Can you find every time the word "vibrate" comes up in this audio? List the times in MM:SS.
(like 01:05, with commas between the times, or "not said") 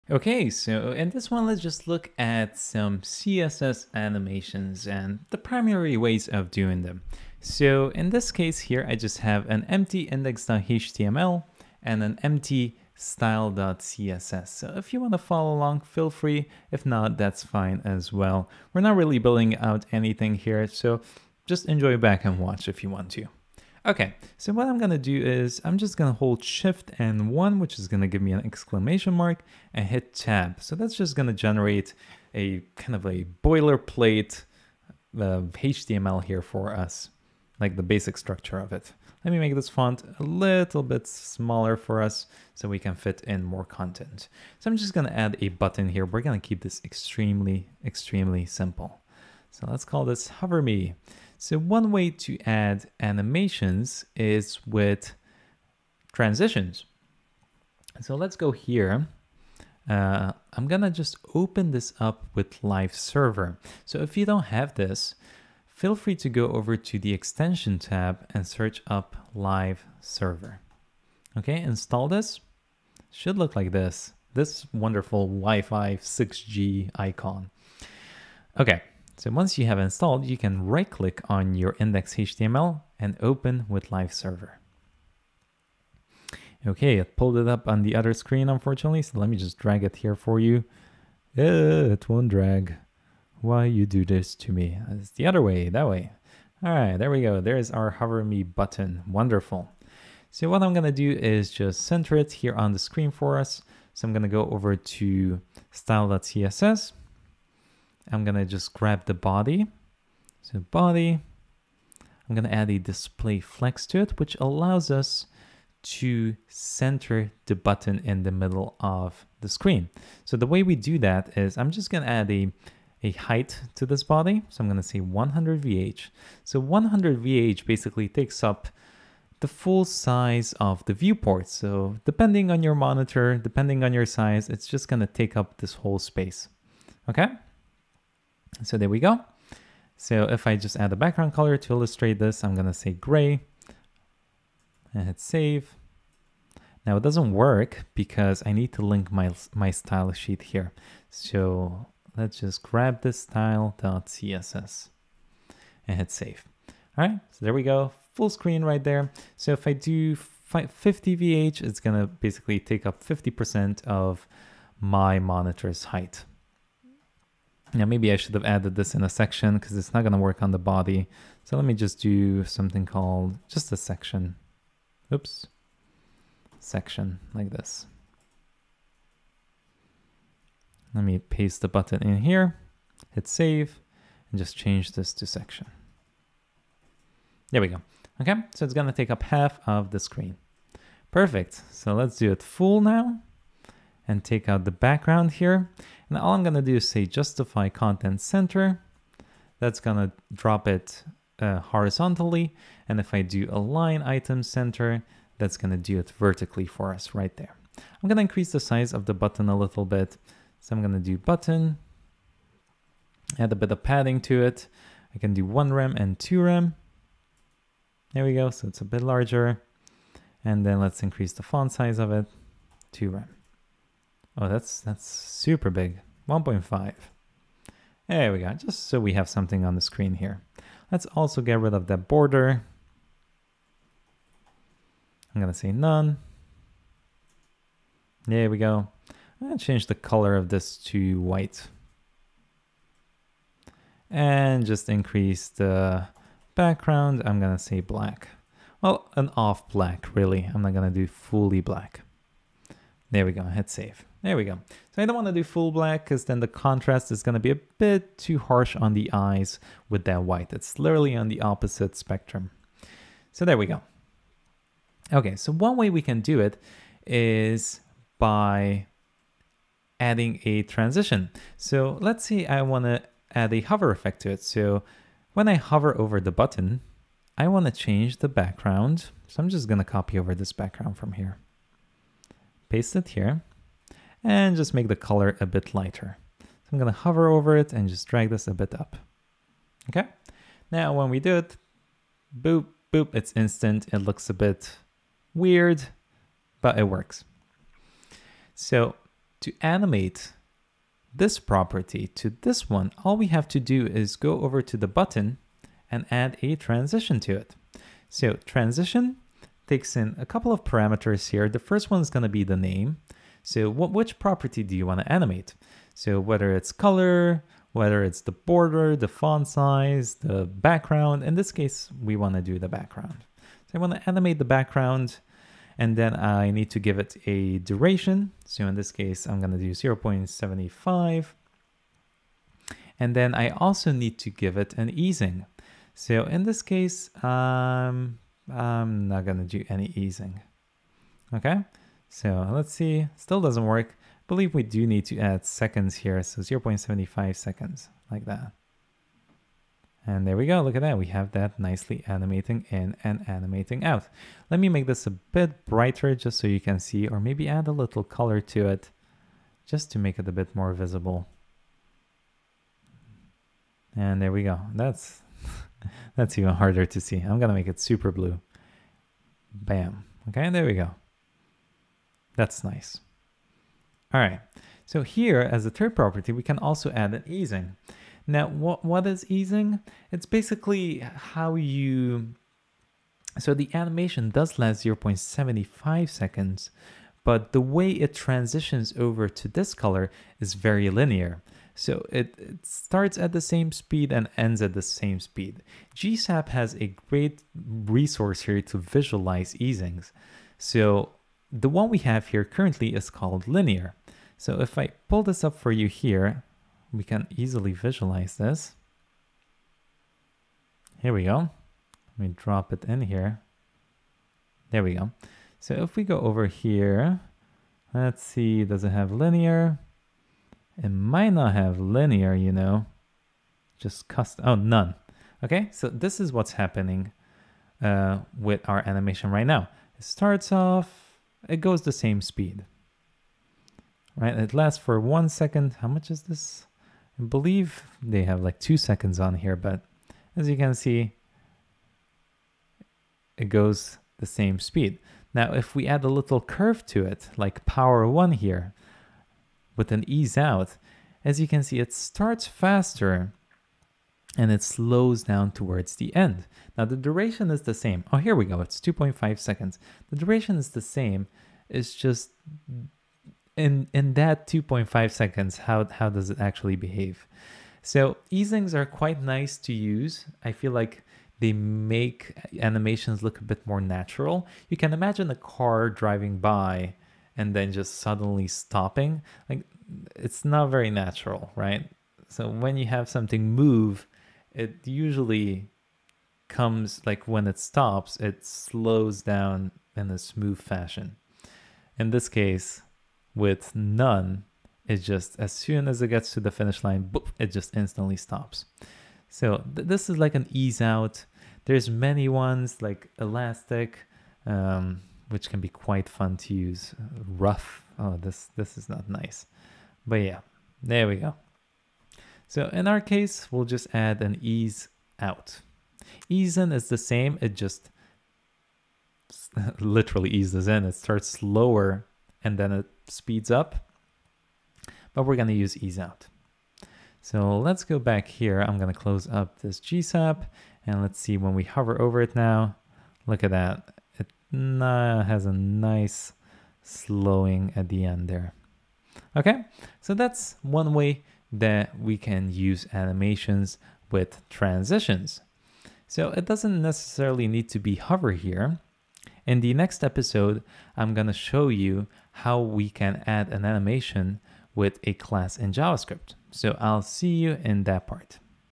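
not said.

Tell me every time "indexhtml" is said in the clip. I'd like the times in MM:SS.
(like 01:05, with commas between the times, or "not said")
00:10, 01:21.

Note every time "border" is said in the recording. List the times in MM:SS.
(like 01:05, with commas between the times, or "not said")
03:52, 05:18.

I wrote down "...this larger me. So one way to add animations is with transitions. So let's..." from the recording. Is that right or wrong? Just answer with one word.
wrong.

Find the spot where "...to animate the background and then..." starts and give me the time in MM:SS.
05:23.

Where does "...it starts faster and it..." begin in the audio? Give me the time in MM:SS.
07:31.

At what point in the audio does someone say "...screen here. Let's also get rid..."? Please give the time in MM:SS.
03:49.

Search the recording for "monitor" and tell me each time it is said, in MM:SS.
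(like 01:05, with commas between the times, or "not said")
02:12, 02:45.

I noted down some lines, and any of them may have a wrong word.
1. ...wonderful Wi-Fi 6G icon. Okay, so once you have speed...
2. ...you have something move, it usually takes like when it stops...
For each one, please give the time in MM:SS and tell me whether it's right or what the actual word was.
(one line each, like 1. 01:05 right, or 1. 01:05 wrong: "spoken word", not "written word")
1. 01:14 wrong: "installed", not "speed"
2. 08:02 wrong: "comes", not "takes".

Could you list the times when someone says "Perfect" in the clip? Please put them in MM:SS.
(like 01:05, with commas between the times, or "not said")
03:11.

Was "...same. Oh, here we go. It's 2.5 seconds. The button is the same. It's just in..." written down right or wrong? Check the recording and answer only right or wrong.
wrong.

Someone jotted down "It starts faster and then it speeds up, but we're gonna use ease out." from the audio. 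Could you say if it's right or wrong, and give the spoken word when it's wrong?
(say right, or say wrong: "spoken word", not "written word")
wrong: "slower", not "faster".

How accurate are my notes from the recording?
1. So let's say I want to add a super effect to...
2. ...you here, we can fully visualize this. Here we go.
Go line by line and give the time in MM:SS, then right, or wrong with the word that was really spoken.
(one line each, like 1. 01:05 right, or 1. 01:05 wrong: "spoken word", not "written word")
1. 04:31 wrong: "hover", not "super"
2. 06:45 wrong: "easily", not "fully".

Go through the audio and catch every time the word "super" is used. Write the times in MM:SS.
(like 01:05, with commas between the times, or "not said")
03:45, 06:07.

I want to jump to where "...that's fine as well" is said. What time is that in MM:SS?
00:17.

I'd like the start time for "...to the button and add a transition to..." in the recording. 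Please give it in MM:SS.
05:04.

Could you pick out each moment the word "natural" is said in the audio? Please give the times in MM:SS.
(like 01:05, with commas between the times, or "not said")
07:53, 08:00.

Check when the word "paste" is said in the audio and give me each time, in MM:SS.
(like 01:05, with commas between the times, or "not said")
03:01, 04:42.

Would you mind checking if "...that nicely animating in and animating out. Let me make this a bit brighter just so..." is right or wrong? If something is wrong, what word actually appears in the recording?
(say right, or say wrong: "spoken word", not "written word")
right.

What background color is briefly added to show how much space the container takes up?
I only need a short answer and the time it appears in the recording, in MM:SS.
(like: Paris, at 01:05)
Gray, at 02:22.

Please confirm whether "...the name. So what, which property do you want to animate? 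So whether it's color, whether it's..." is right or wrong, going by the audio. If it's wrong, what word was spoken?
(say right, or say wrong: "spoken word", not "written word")
right.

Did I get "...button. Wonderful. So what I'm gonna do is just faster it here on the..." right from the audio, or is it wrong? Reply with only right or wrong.
wrong.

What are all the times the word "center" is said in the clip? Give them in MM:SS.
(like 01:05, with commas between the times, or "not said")
01:41, 01:56, 03:18, 03:24.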